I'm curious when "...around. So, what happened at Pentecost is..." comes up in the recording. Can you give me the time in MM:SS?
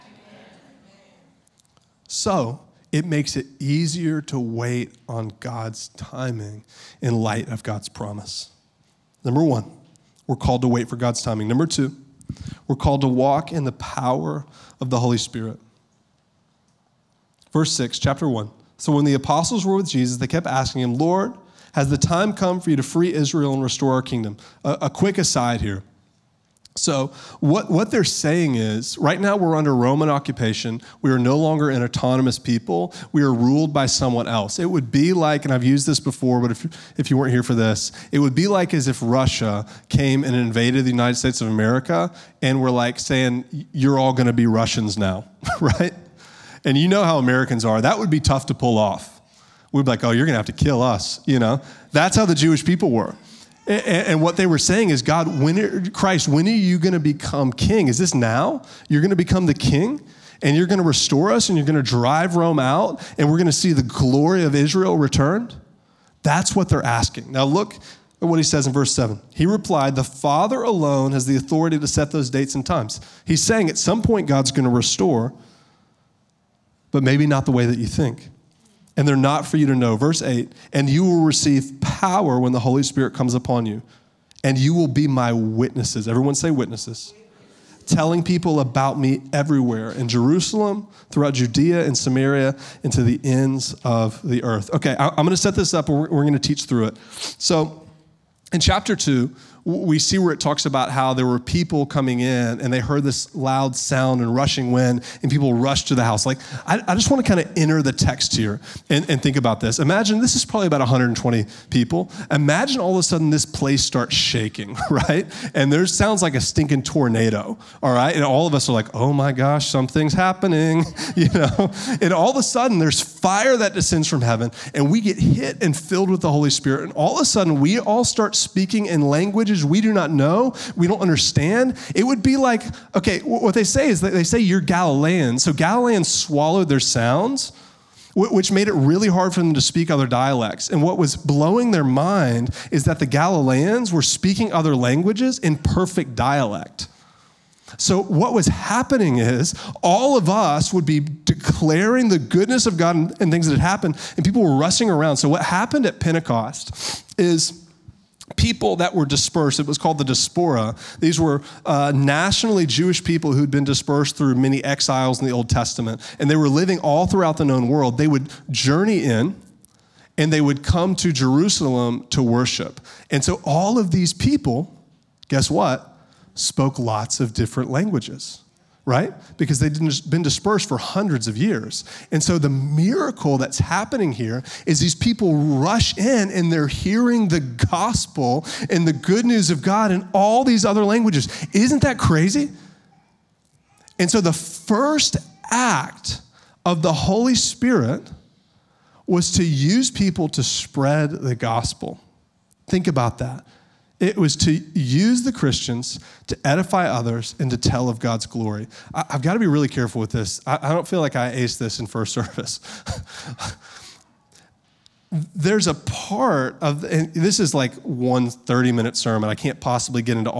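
02:34.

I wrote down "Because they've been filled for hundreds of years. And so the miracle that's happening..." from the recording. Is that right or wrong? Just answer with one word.
wrong.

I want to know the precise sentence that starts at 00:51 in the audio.
You know, that's how the Jewish people were.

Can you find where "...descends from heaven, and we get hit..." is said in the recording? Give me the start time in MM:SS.
02:03.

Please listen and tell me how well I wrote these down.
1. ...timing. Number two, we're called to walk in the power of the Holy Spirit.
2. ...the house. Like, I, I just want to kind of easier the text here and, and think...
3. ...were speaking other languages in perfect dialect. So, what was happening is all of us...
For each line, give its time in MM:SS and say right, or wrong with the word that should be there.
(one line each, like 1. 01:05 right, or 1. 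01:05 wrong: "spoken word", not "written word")
1. 00:11 right
2. 01:45 wrong: "enter", not "easier"
3. 02:23 right.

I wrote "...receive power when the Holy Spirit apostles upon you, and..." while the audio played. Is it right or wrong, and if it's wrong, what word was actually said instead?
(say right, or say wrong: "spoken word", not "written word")
wrong: "comes", not "apostles".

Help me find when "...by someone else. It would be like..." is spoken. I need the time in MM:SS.
00:33.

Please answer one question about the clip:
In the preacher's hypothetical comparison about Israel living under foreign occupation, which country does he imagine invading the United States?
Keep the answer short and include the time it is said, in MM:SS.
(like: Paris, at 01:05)
Russia, at 00:39.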